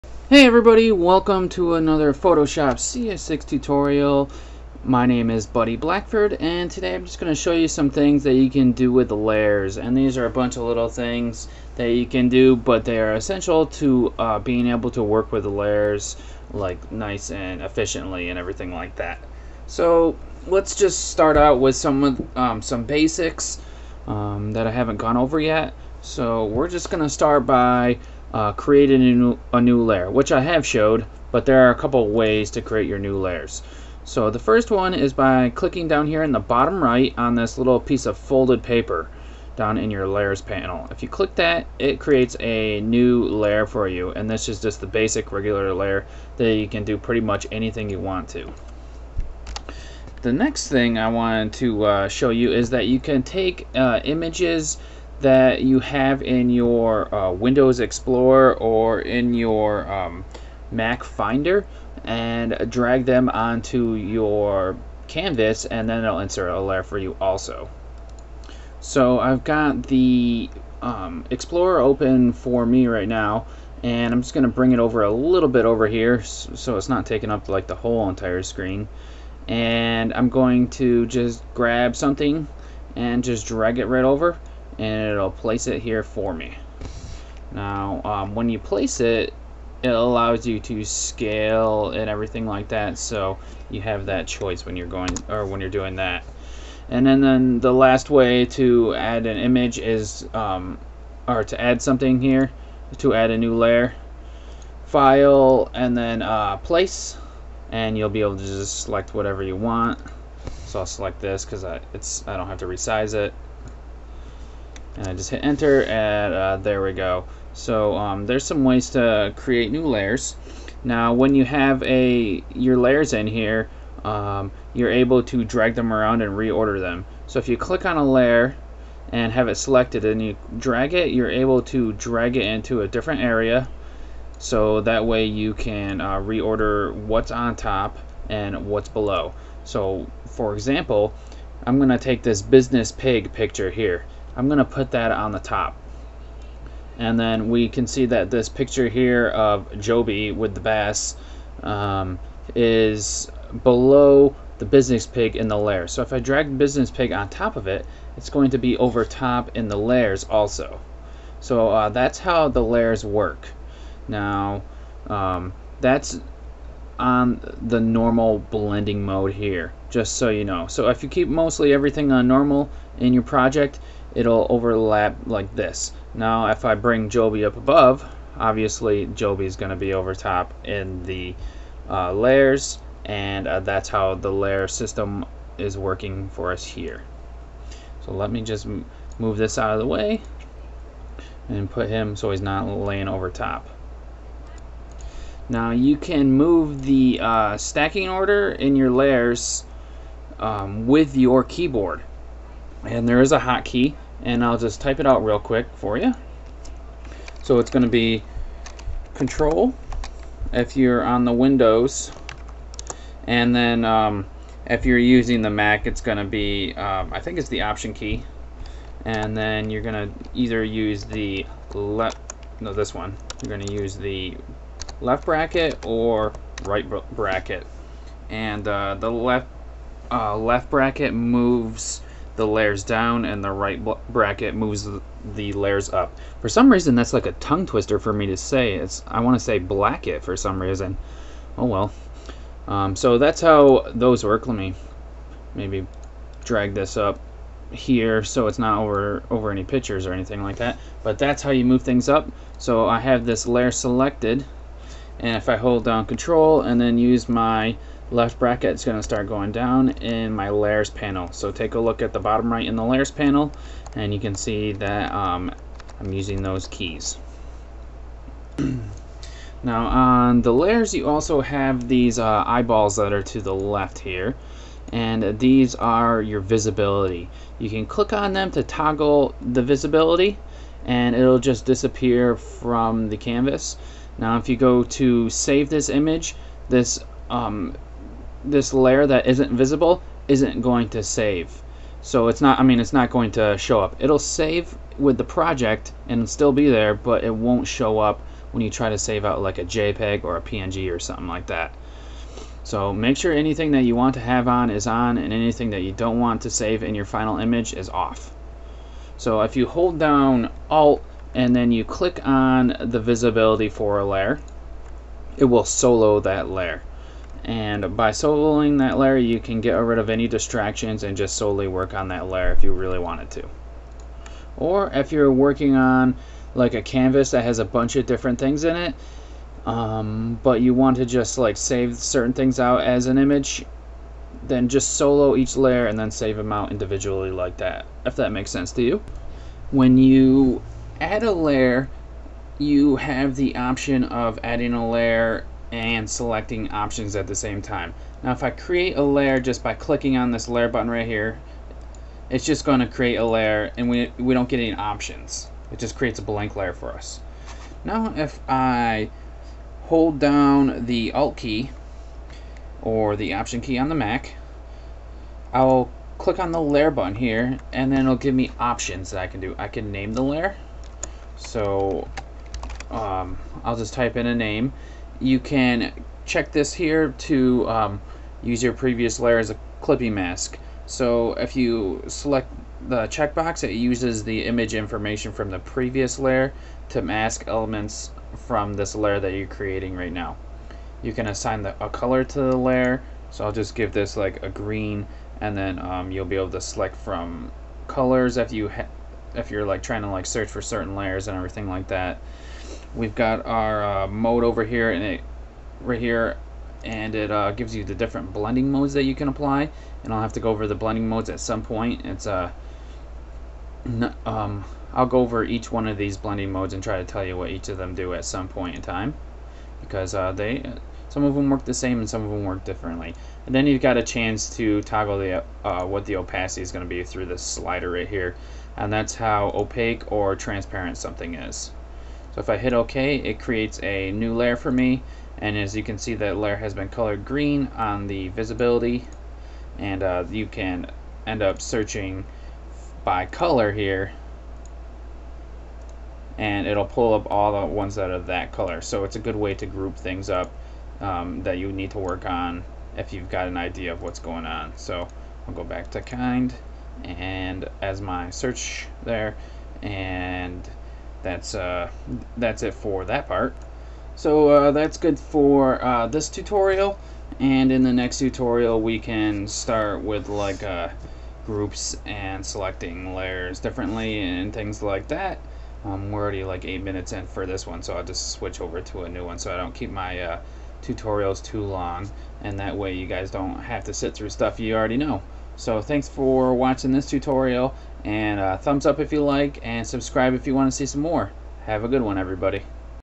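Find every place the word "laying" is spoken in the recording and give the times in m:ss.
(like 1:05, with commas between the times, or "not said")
3:12.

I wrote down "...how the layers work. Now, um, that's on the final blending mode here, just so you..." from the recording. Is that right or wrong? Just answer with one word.
wrong.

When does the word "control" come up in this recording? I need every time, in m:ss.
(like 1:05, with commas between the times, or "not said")
3:29, 4:16.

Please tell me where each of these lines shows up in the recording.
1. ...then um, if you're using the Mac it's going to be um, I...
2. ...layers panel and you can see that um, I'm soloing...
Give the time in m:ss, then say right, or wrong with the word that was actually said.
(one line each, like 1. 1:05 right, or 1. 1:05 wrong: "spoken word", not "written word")
1. 3:33 right
2. 4:22 wrong: "using", not "soloing".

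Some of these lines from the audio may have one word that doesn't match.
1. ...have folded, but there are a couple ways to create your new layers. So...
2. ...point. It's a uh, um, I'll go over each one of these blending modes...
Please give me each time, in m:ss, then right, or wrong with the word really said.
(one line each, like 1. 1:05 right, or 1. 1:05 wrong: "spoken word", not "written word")
1. 0:30 wrong: "showed", not "folded"
2. 6:51 right.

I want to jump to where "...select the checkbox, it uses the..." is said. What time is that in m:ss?
6:22.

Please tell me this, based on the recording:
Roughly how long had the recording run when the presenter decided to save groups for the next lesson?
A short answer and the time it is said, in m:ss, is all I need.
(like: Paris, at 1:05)
8 minutes, at 7:56.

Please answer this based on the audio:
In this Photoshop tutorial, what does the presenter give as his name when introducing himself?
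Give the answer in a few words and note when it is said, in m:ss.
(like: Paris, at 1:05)
Buddy Blackford, at 0:05.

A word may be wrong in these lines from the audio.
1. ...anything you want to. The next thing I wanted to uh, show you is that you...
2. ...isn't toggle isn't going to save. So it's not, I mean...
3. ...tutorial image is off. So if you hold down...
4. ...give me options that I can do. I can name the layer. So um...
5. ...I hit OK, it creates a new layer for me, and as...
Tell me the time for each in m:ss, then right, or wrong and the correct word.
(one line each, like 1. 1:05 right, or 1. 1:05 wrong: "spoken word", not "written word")
1. 0:47 right
2. 4:49 wrong: "visible", not "toggle"
3. 5:07 wrong: "final", not "tutorial"
4. 6:08 right
5. 7:12 right.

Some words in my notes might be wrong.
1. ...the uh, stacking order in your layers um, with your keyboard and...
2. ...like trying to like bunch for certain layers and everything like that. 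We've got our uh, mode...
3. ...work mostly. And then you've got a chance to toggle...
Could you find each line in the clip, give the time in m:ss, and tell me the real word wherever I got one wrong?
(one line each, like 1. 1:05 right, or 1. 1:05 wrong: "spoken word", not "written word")
1. 3:16 right
2. 6:39 wrong: "search", not "bunch"
3. 7:02 wrong: "differently", not "mostly".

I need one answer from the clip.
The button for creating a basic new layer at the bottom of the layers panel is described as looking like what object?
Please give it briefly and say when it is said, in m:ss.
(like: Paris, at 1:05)
folded paper, at 0:38.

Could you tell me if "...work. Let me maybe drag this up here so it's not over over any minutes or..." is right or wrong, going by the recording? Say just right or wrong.
wrong.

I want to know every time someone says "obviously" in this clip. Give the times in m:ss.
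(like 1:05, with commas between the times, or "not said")
2:58.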